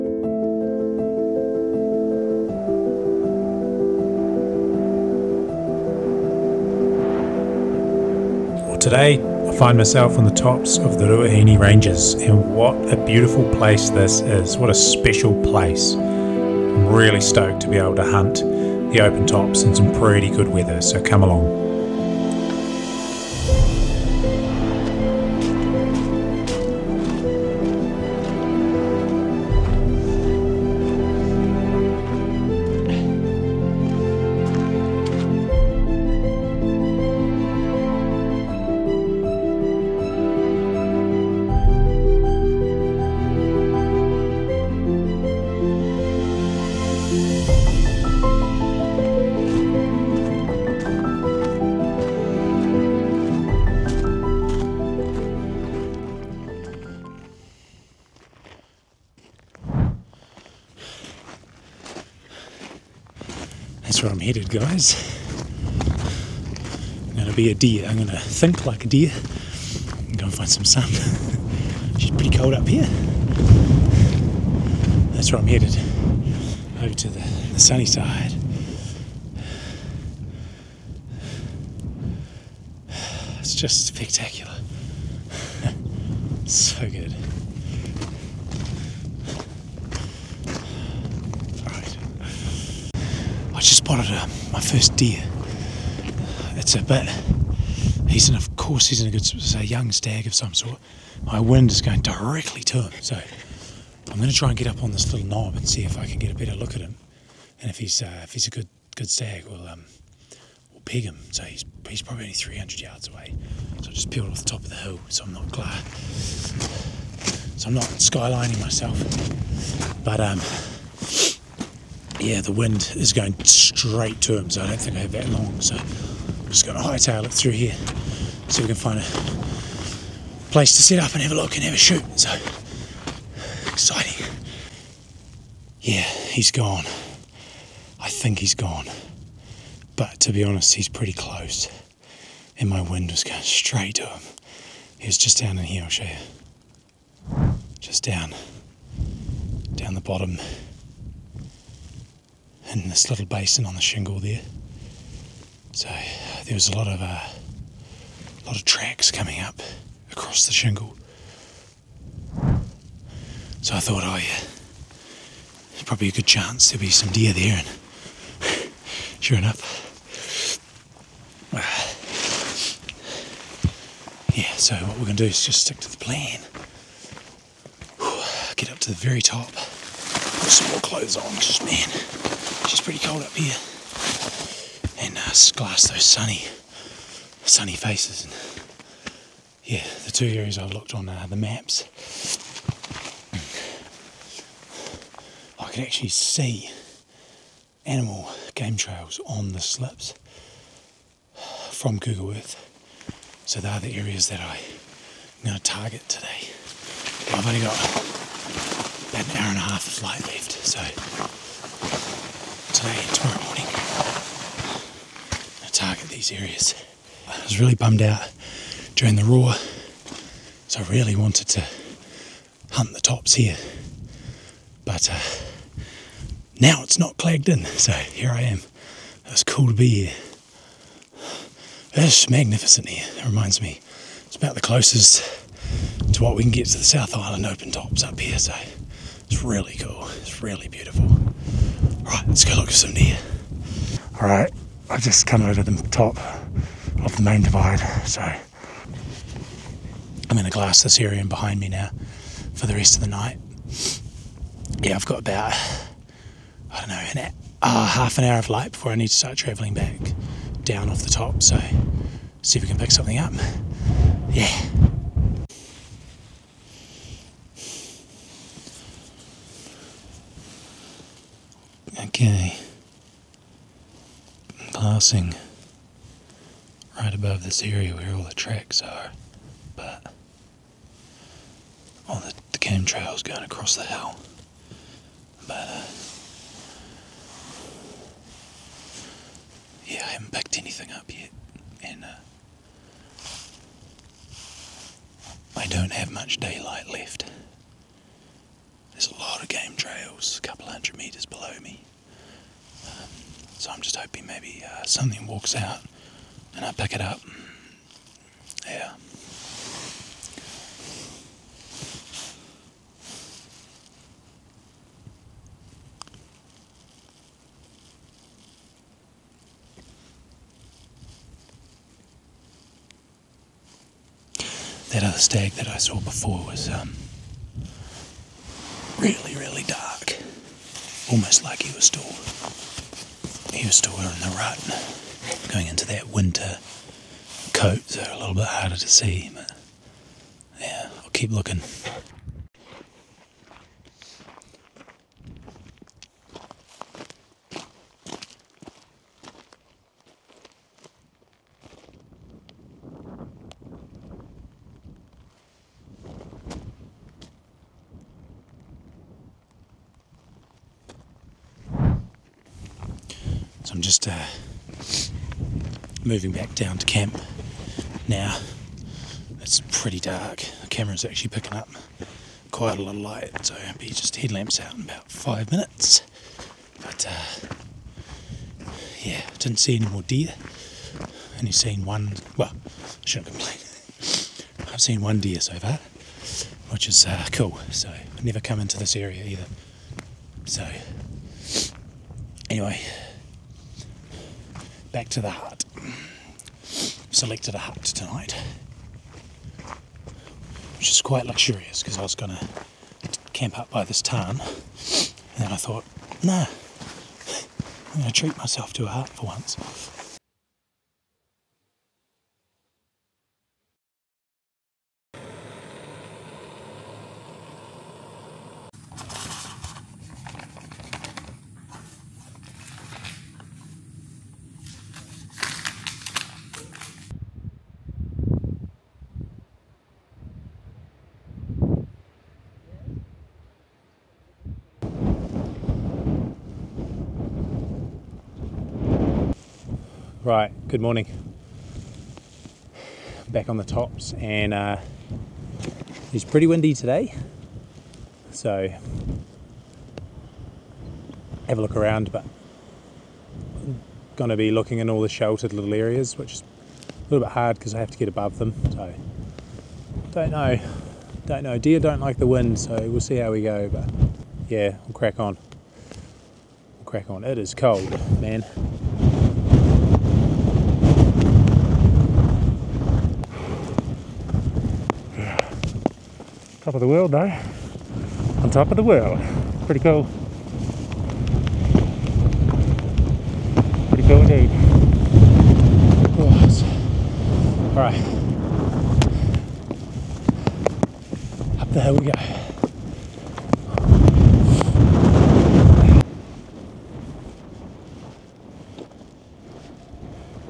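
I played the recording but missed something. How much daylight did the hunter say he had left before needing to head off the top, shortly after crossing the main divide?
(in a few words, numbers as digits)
half an hour.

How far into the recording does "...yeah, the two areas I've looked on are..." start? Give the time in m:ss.
3:09.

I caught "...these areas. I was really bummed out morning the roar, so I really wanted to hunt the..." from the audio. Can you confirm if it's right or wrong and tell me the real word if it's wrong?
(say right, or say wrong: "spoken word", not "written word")
wrong: "during", not "morning".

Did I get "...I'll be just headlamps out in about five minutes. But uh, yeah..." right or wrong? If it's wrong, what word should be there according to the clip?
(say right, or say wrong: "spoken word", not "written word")
right.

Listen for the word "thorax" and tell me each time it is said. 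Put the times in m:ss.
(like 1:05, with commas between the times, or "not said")
not said.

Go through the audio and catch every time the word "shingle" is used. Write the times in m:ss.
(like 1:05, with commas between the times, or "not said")
2:33, 2:40.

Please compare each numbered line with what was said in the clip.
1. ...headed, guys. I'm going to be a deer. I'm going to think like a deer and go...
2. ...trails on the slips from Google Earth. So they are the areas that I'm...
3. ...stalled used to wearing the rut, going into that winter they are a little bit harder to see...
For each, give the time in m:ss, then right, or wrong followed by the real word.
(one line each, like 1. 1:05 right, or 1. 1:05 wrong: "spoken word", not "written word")
1. 1:04 right
2. 3:18 right
3. 5:31 right.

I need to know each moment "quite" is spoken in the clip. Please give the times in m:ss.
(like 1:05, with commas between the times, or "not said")
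6:12, 6:41.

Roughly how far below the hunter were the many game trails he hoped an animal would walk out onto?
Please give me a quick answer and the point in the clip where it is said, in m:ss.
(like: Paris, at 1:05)
a couple hundred meters, at 5:00.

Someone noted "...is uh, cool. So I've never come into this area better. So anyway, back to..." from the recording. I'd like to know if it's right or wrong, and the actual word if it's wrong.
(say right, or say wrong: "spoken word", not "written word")
wrong: "either", not "better".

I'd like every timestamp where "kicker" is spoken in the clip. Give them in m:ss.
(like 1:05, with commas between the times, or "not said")
not said.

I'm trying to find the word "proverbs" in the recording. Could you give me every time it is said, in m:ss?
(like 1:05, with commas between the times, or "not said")
not said.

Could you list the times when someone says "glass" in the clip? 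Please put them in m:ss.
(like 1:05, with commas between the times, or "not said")
3:05, 4:10.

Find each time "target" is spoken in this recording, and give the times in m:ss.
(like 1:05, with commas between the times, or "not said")
3:25, 3:35.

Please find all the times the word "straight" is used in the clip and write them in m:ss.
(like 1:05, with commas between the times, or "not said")
2:03, 2:23.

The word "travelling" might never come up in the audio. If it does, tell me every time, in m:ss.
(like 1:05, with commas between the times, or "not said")
4:19.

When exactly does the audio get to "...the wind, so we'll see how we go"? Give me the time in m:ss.
7:42.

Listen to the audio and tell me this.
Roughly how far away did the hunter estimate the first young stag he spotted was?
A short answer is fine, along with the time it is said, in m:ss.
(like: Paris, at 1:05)
300 yards, at 1:52.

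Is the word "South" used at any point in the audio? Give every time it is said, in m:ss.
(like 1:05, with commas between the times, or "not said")
3:56.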